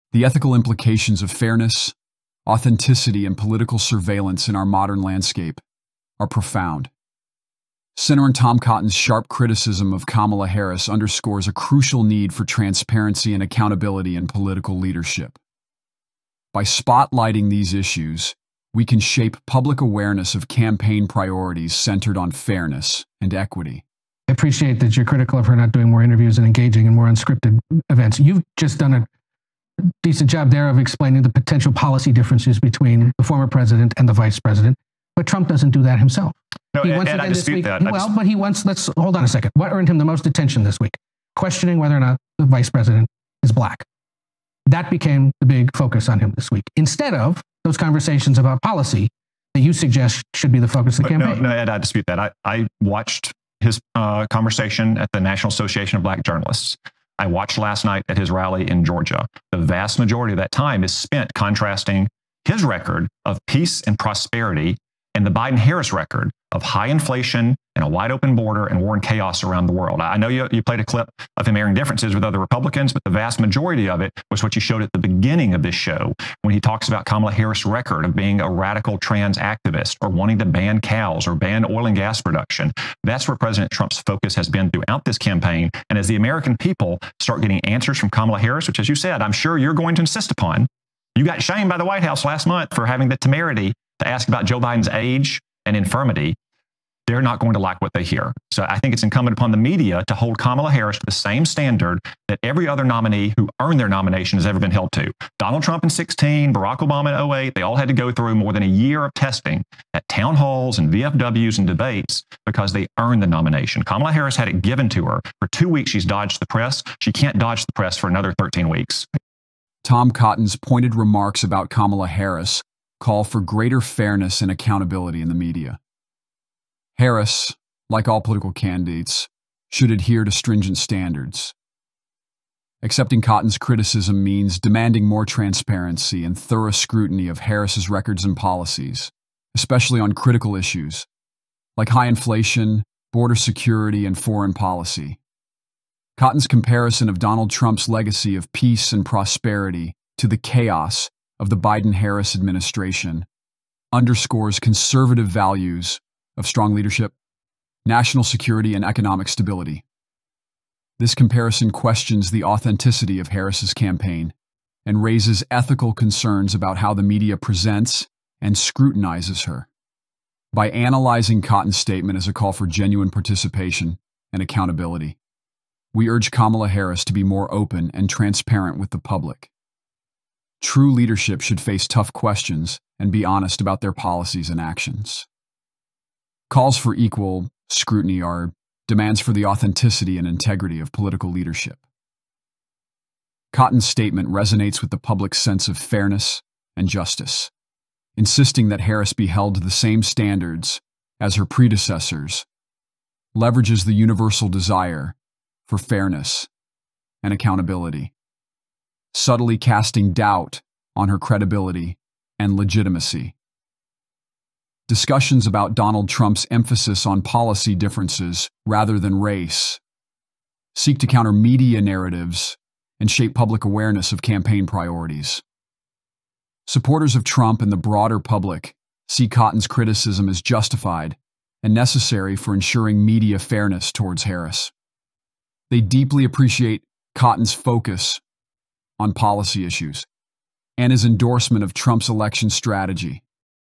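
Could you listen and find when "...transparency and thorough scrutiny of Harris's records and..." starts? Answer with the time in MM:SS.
02:15.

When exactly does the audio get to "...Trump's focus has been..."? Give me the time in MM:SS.
01:23.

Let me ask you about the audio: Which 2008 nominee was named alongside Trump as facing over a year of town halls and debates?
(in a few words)
Barack Obama.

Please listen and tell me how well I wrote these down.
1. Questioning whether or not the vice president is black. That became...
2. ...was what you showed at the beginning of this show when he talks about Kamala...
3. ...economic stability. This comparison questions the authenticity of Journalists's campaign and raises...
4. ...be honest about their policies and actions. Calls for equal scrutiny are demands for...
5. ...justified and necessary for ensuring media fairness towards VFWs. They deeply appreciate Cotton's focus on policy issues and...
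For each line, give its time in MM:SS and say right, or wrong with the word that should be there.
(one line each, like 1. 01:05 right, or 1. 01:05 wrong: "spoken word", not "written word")
1. 00:41 right
2. 01:14 right
3. 02:38 wrong: "Harris", not "Journalists"
4. 03:03 right
5. 03:50 wrong: "Harris", not "VFWs".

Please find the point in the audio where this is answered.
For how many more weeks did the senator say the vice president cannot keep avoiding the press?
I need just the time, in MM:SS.
01:58.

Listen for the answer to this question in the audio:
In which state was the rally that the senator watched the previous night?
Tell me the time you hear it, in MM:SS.
00:58.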